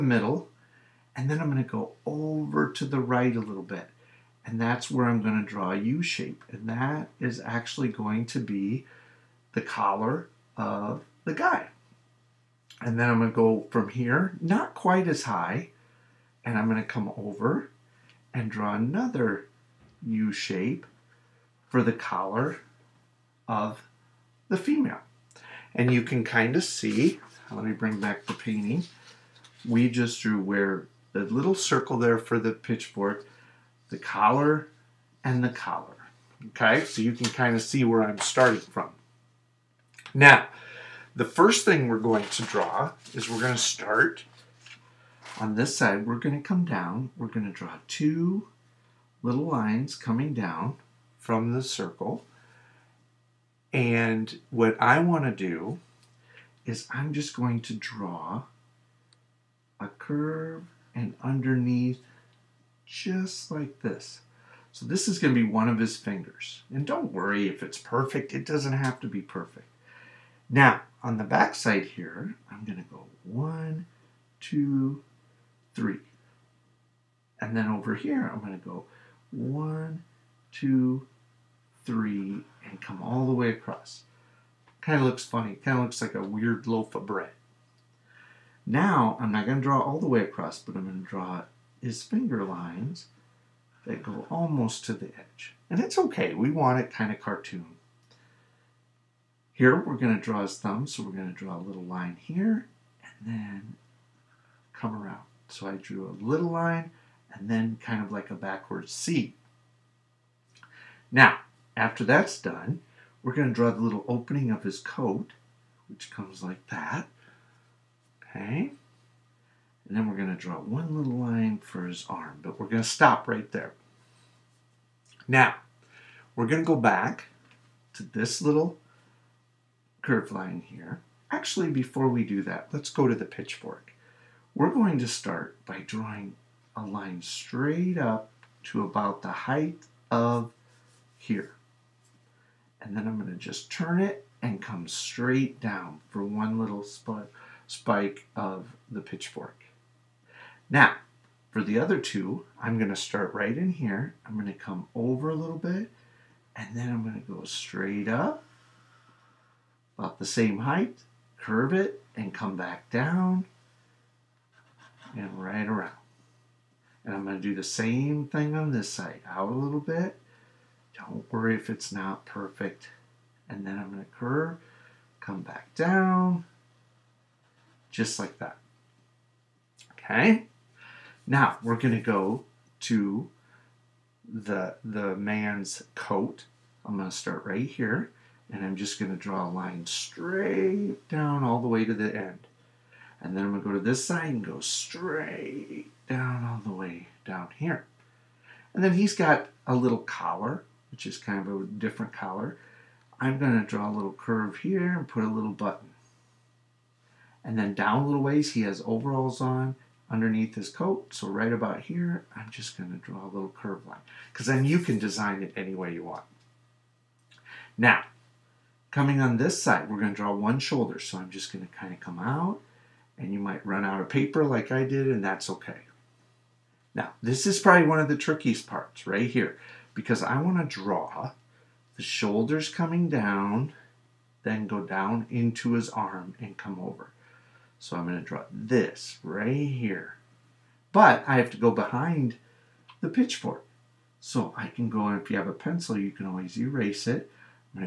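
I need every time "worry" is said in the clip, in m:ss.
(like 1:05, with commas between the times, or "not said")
1:07, 2:51.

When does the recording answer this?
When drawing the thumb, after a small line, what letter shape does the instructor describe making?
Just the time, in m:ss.
1:48.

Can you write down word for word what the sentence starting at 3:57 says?
So I'm going to draw this right here.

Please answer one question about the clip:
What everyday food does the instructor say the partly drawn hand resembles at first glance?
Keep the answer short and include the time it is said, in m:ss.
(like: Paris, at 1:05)
a weird loaf of bread, at 1:26.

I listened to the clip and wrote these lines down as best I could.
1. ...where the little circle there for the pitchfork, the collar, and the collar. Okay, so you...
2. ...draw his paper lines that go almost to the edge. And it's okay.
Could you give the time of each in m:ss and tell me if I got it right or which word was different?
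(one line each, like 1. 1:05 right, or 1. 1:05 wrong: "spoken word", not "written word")
1. 0:30 right
2. 1:31 wrong: "finger", not "paper".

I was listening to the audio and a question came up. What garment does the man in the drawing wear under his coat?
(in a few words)
overalls.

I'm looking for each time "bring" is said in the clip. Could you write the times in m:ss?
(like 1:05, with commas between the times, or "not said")
0:27.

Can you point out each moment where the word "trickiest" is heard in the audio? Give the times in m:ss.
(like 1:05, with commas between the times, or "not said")
3:48.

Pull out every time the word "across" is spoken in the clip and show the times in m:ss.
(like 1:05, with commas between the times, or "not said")
1:23, 1:30.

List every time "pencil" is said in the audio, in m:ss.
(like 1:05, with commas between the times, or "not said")
4:05.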